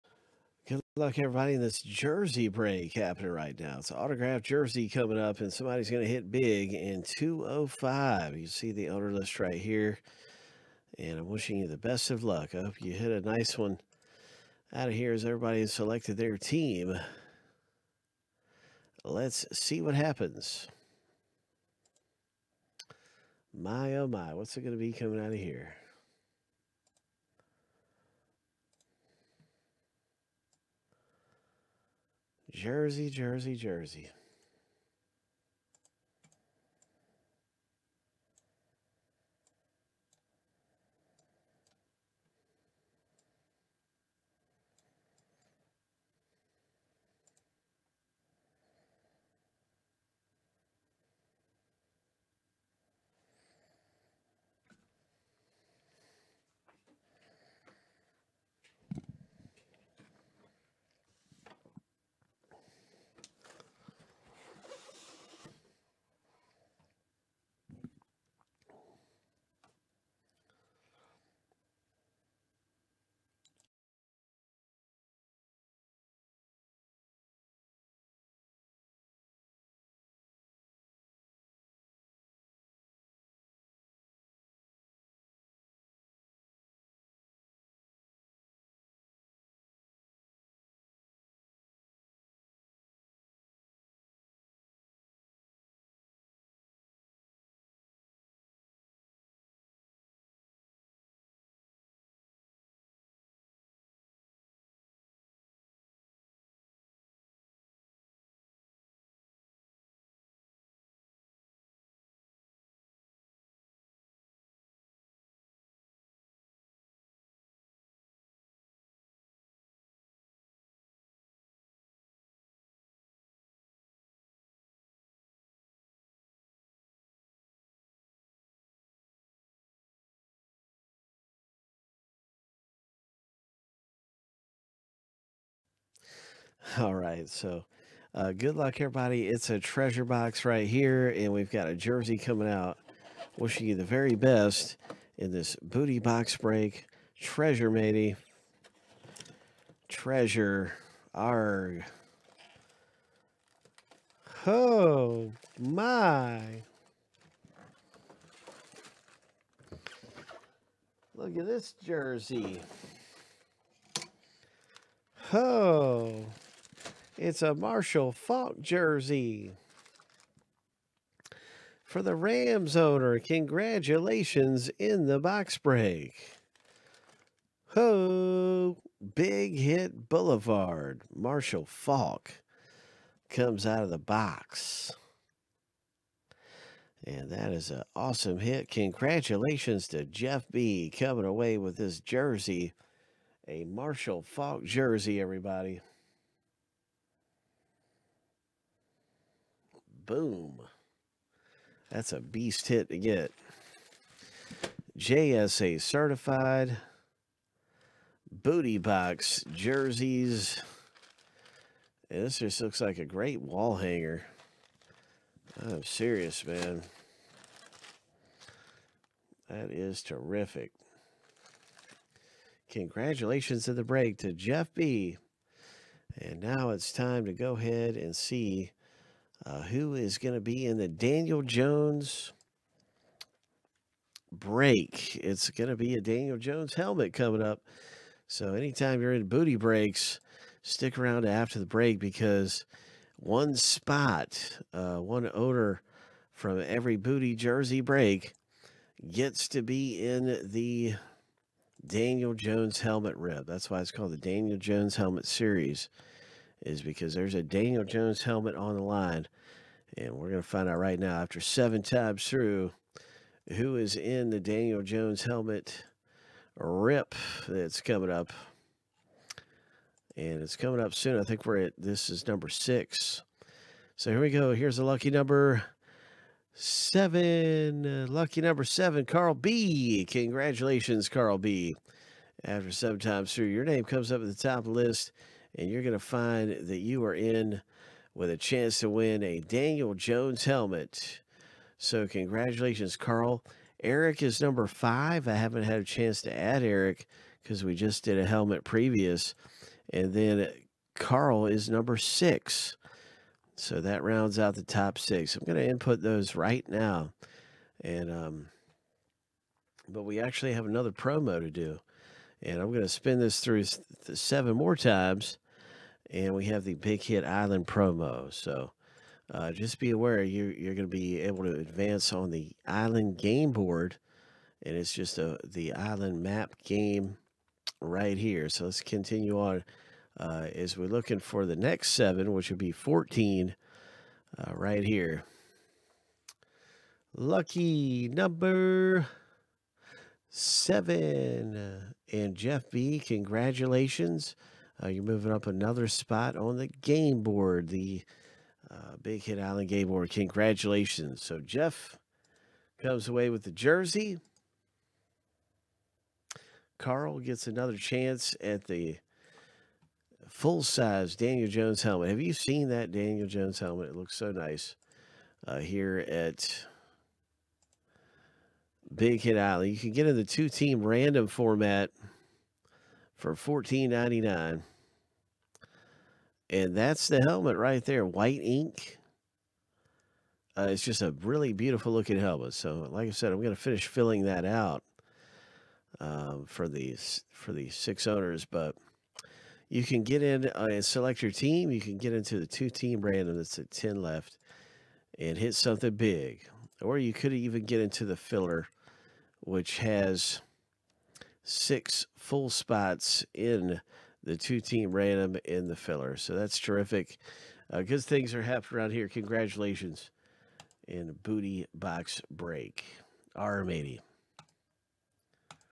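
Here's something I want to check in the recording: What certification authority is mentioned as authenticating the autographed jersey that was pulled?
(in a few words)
JSA.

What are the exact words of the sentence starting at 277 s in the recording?
Uh, lucky number seven, Carl B.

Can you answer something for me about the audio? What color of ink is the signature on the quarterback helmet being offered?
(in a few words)
White.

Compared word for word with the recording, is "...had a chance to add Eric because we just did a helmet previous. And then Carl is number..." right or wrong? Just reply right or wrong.
right.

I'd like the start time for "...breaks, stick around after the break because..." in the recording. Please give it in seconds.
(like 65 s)
239 s.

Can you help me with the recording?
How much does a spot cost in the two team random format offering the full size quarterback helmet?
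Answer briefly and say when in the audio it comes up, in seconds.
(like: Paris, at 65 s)
$14.99, at 373 s.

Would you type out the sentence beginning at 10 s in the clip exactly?
And I'm wishing you the best of luck.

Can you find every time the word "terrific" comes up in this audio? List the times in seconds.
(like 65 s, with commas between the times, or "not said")
220 s, 406 s.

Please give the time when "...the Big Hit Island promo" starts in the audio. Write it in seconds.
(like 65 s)
316 s.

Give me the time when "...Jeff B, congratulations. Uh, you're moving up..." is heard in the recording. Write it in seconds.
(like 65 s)
342 s.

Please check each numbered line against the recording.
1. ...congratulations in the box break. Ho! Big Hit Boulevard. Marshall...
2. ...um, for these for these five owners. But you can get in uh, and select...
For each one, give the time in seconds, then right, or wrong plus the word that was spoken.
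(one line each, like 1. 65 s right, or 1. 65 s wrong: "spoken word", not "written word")
1. 173 s right
2. 386 s wrong: "six", not "five".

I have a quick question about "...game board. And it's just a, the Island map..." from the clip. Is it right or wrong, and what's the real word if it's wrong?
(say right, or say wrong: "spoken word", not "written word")
right.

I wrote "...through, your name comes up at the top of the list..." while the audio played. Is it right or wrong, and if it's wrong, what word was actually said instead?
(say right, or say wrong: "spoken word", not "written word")
right.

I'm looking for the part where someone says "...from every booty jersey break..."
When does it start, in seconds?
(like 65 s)
246 s.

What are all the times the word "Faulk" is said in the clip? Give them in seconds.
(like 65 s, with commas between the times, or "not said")
168 s, 181 s, 194 s.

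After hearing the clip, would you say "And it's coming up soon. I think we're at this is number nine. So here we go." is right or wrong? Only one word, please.
wrong.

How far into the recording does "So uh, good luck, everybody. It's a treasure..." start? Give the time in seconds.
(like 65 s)
137 s.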